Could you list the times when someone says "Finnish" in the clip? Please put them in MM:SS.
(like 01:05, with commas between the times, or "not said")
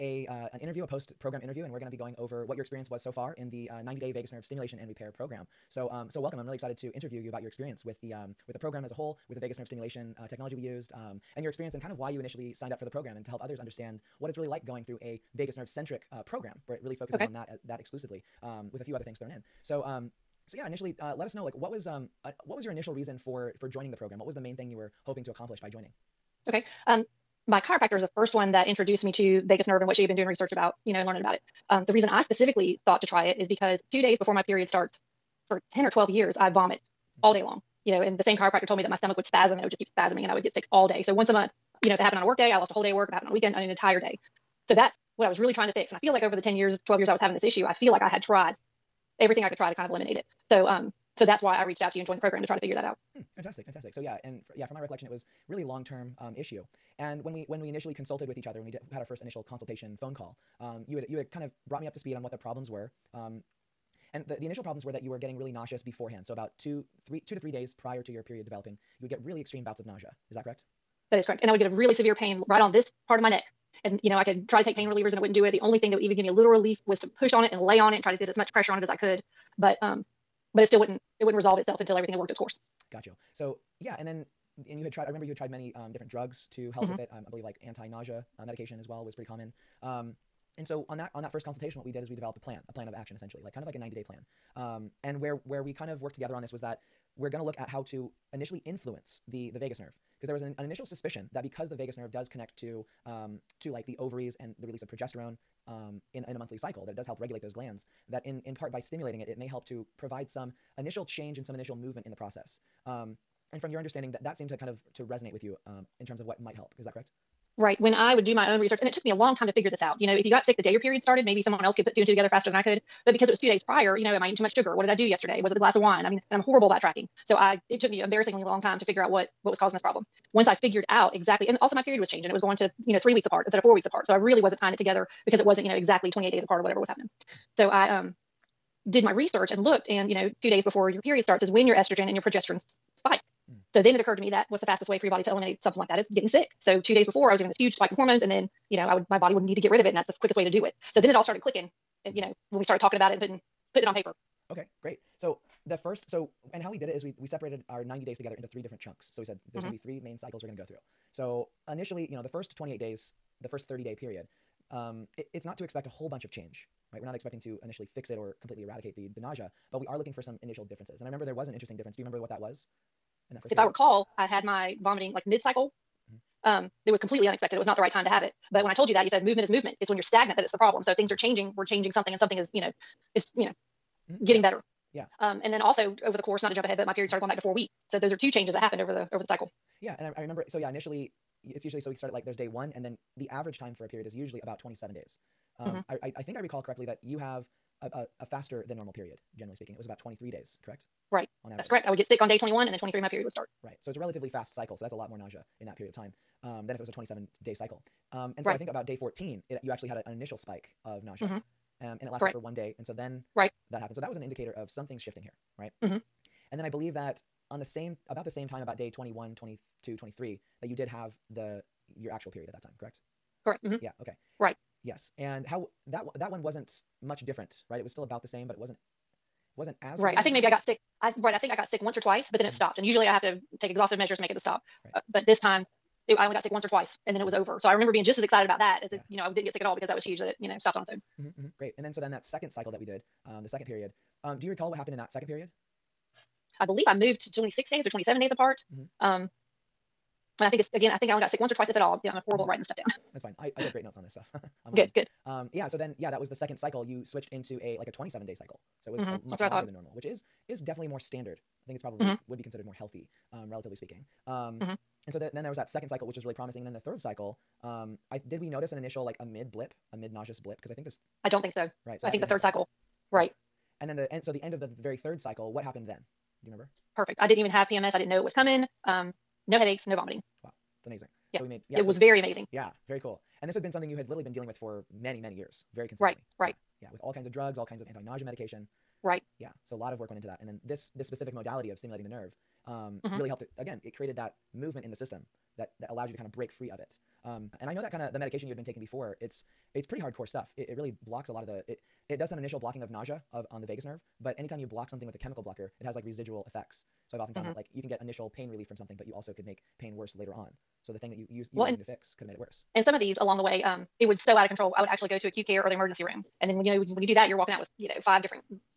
not said.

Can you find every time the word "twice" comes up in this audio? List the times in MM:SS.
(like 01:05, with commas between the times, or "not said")
03:52, 03:56, 04:11.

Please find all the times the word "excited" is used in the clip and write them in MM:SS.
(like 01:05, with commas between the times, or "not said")
00:06, 03:58.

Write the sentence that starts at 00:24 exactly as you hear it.
What was the main thing you were hoping to accomplish by joining?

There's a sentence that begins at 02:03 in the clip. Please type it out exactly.
But because it was two days prior, you know, am I eating too much sugar?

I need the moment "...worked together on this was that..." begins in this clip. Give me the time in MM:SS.
01:36.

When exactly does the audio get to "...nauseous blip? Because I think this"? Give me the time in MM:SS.
04:30.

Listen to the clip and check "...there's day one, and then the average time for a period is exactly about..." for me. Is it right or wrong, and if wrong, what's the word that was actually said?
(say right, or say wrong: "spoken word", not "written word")
wrong: "usually", not "exactly".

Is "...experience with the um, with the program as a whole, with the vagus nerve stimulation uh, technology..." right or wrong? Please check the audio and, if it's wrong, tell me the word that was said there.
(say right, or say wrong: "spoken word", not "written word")
right.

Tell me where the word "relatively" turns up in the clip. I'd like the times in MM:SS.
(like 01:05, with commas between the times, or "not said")
03:23, 04:23.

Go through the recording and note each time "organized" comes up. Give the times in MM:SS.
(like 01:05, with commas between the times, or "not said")
not said.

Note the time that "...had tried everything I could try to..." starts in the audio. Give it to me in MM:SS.
00:48.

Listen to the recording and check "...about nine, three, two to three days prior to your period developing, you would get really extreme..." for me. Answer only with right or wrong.
wrong.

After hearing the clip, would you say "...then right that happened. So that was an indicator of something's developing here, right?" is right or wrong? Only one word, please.
wrong.